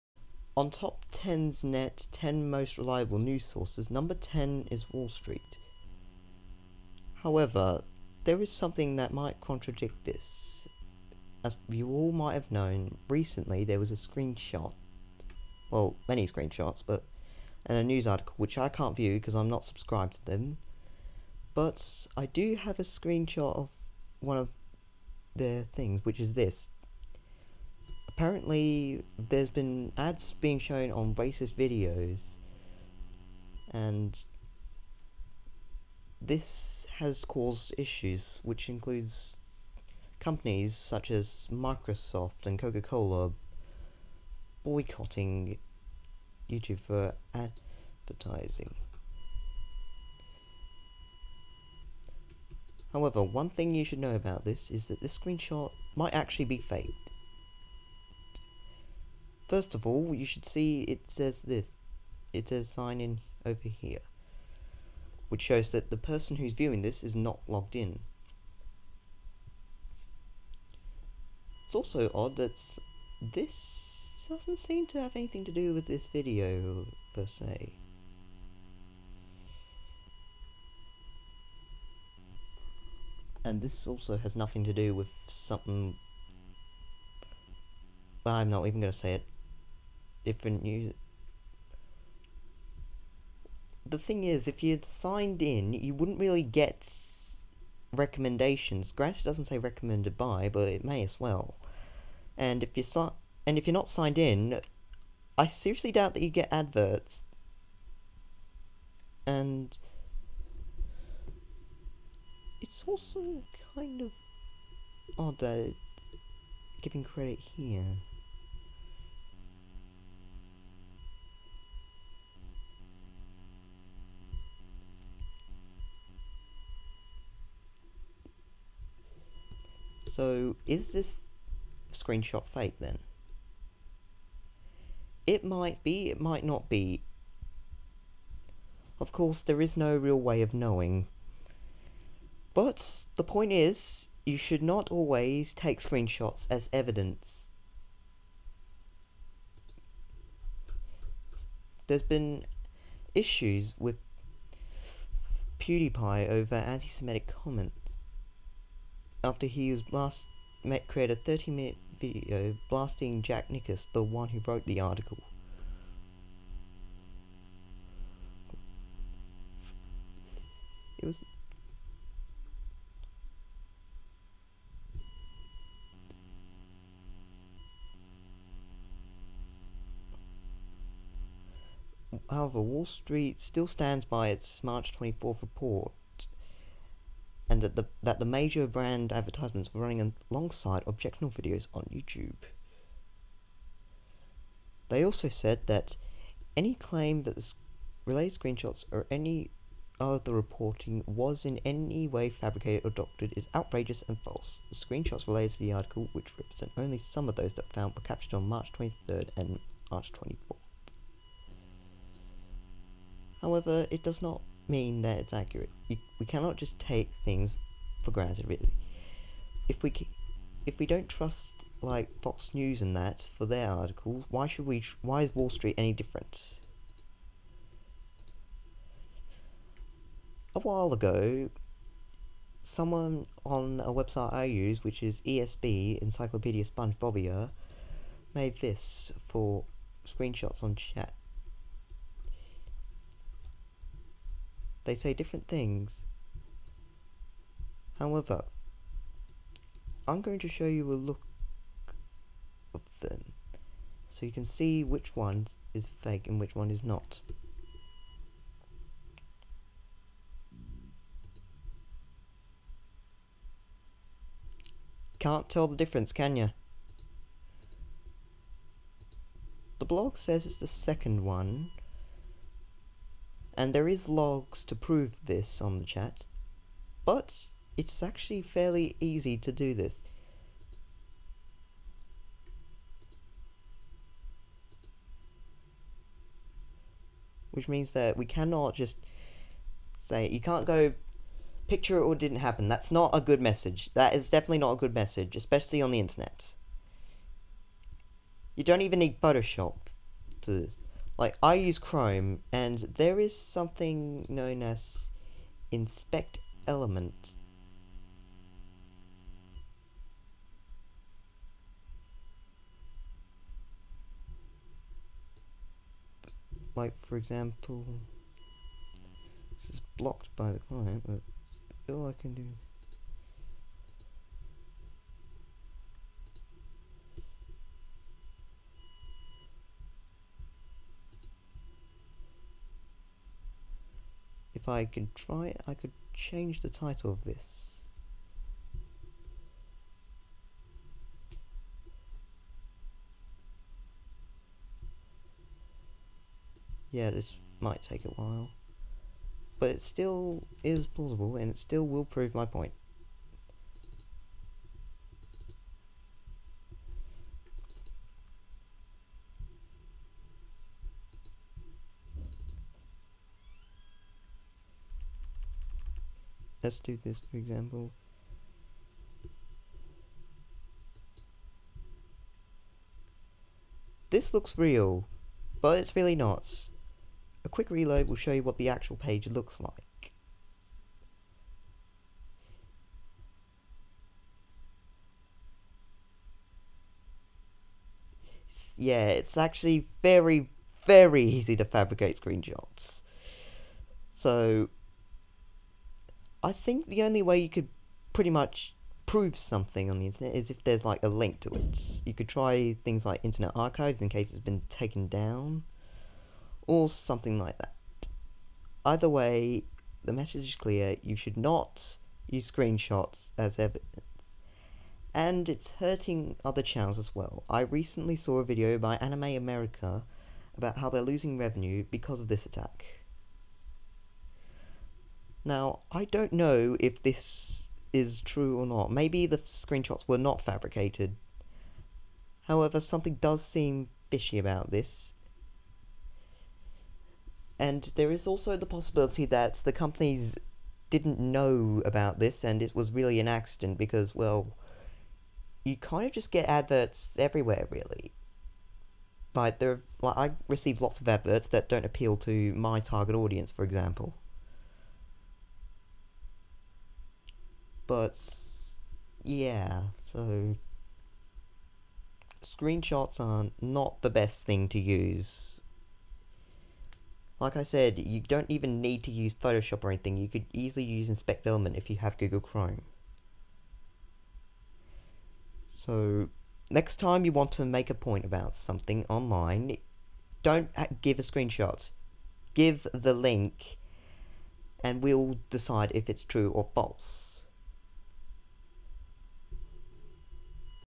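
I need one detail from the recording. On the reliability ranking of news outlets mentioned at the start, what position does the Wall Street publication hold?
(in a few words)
10.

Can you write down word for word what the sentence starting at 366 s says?
let's do this For example This looks real, but it's really not.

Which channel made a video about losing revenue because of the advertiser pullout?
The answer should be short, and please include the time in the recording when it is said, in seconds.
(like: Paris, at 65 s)
Anime America, at 418 s.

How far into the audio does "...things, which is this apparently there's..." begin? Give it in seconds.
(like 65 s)
25 s.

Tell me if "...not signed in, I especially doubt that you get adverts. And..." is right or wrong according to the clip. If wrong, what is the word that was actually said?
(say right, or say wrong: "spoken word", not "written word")
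wrong: "seriously", not "especially".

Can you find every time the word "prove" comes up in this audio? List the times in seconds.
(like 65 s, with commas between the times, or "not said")
274 s, 352 s, 399 s.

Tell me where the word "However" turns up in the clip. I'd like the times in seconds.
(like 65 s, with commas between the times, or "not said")
7 s, 52 s, 182 s, 213 s, 247 s, 432 s.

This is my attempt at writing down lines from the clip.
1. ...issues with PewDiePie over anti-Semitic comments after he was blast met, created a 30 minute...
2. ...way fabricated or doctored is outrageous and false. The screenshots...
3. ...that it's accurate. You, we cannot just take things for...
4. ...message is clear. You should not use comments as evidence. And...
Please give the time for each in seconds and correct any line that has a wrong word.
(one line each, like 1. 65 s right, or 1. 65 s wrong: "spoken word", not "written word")
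1. 153 s right
2. 202 s right
3. 215 s right
4. 410 s wrong: "screenshots", not "comments".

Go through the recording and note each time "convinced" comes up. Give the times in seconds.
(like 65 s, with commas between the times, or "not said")
not said.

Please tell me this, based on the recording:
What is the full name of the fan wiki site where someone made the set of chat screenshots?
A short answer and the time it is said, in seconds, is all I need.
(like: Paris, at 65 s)
Encyclopedia SpongeBobia, at 235 s.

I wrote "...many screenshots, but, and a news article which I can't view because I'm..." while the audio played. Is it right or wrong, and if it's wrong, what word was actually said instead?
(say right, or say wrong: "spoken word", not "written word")
right.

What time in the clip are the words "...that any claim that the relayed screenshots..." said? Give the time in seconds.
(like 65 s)
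195 s.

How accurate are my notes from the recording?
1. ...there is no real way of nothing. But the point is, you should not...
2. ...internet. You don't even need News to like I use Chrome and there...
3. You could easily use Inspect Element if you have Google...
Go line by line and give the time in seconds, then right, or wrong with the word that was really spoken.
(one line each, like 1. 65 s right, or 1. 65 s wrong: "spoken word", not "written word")
1. 139 s wrong: "knowing", not "nothing"
2. 295 s wrong: "Photoshop", not "News"
3. 470 s right.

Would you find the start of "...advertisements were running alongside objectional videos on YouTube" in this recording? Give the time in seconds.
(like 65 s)
189 s.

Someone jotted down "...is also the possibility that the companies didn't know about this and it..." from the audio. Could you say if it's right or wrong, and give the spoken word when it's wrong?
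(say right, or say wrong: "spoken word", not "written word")
right.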